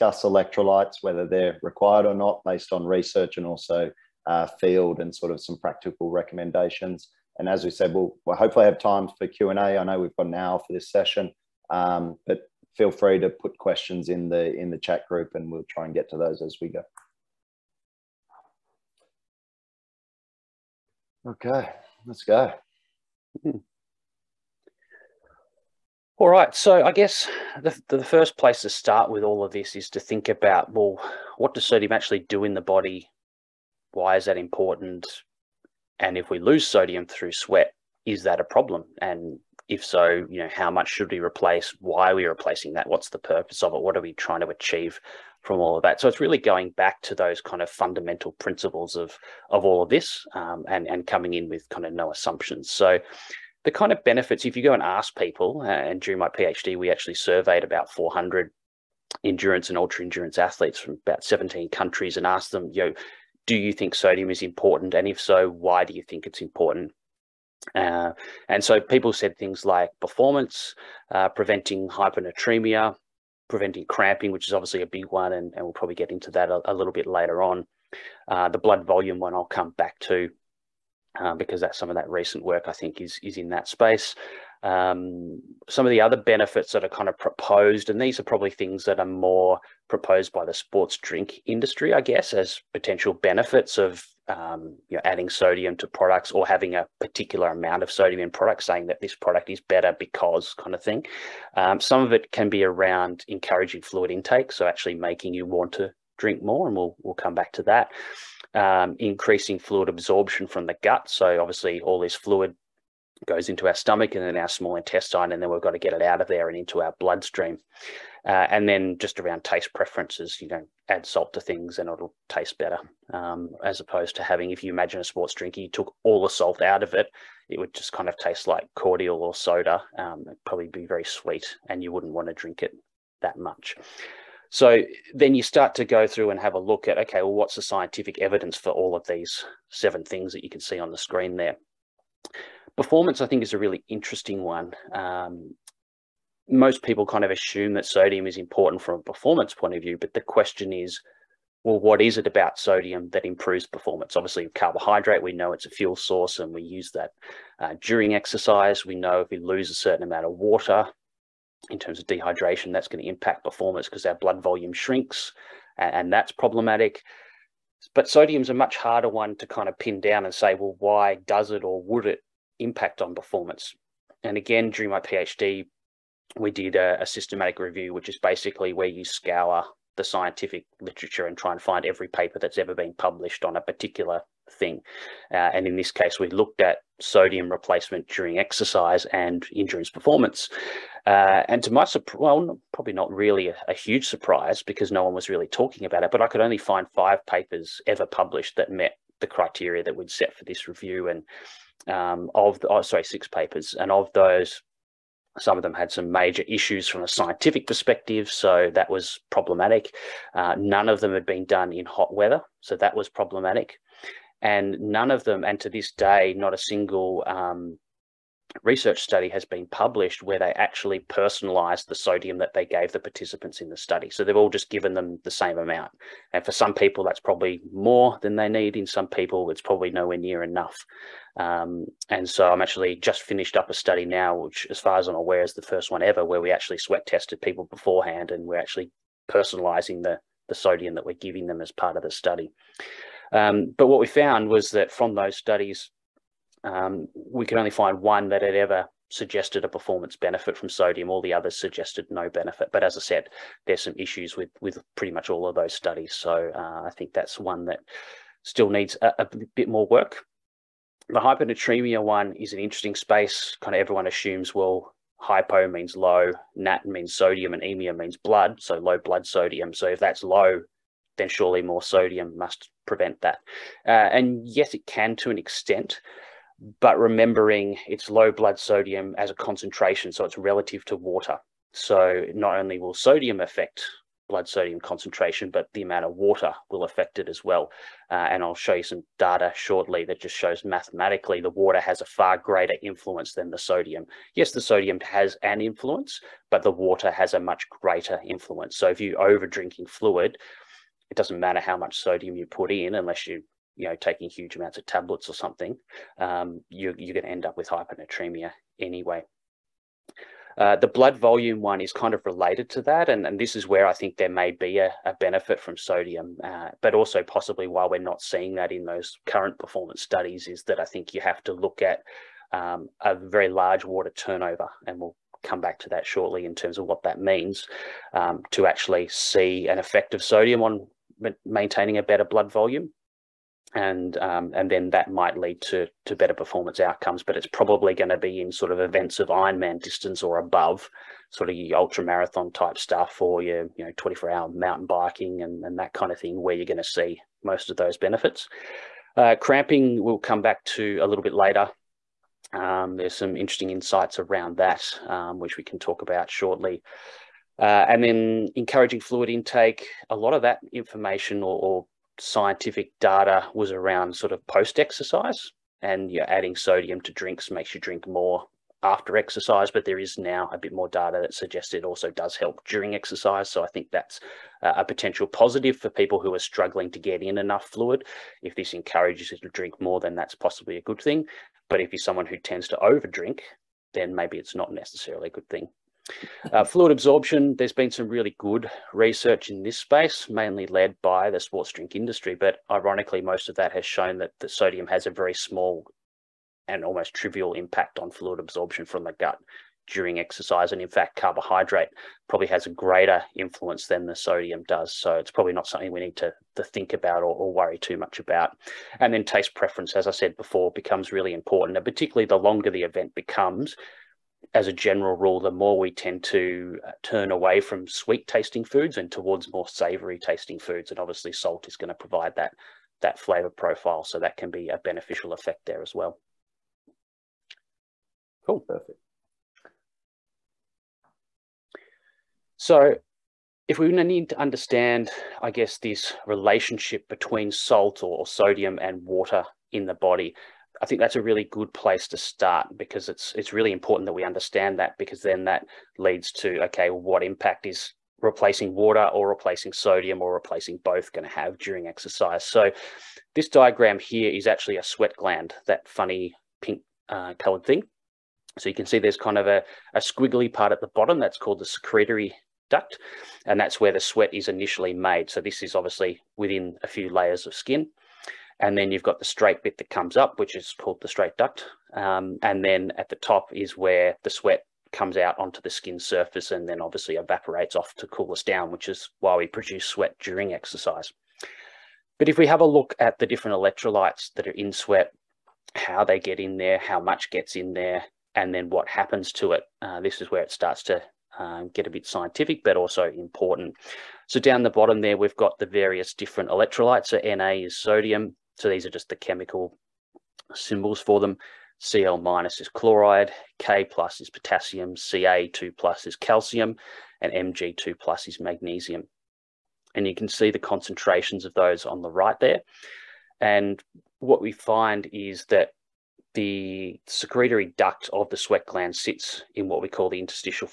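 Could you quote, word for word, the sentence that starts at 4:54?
Yes, the sodium has an influence, but the water has a much greater influence.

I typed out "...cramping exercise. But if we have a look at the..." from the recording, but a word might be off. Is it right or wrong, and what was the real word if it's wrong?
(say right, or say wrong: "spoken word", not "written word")
wrong: "during", not "cramping".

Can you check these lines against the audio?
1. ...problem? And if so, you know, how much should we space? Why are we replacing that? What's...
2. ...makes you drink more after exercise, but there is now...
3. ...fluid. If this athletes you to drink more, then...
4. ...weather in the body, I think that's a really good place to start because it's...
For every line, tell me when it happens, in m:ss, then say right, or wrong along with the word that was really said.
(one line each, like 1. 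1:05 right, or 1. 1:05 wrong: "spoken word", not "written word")
1. 0:38 wrong: "replace", not "space"
2. 6:07 right
3. 6:17 wrong: "encourages", not "athletes"
4. 7:19 wrong: "water", not "weather".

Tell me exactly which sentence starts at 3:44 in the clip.
So they've all just given them the same amount.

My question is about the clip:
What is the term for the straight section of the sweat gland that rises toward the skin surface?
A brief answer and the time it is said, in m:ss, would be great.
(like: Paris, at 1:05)
Straight duct, at 7:51.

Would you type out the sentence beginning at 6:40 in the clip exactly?
And in fact, carbohydrate probably has a greater influence than the sodium does.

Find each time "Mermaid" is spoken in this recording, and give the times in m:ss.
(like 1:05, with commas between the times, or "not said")
not said.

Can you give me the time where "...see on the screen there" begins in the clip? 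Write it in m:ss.
2:20.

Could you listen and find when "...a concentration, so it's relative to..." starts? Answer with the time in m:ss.
4:39.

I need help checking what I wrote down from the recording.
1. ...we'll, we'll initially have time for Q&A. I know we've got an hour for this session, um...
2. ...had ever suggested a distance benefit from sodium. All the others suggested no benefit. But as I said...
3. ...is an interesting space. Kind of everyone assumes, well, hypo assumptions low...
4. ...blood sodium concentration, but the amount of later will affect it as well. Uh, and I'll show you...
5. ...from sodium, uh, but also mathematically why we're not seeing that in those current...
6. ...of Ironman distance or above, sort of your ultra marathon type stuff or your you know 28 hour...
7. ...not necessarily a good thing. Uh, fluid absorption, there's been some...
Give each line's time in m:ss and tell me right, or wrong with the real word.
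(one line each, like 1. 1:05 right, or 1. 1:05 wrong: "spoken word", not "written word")
1. 0:07 wrong: "hopefully", not "initially"
2. 4:08 wrong: "performance", not "distance"
3. 4:22 wrong: "means", not "assumptions"
4. 4:44 wrong: "water", not "later"
5. 5:15 wrong: "possibly", not "mathematically"
6. 5:39 wrong: "24", not "28"
7. 6:24 right.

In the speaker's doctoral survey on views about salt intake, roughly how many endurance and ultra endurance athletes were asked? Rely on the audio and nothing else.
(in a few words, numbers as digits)
400.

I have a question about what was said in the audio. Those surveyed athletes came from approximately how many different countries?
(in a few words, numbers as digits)
17.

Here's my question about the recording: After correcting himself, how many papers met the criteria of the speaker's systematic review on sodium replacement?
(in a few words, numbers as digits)
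6.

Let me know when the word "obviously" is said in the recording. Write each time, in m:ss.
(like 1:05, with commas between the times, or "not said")
1:14, 1:51, 2:34, 7:00, 7:45, 7:56.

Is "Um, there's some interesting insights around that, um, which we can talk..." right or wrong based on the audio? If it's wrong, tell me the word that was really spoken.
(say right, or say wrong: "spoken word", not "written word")
right.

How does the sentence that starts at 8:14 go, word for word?
So down the bottom there, we've got the various different electrolytes.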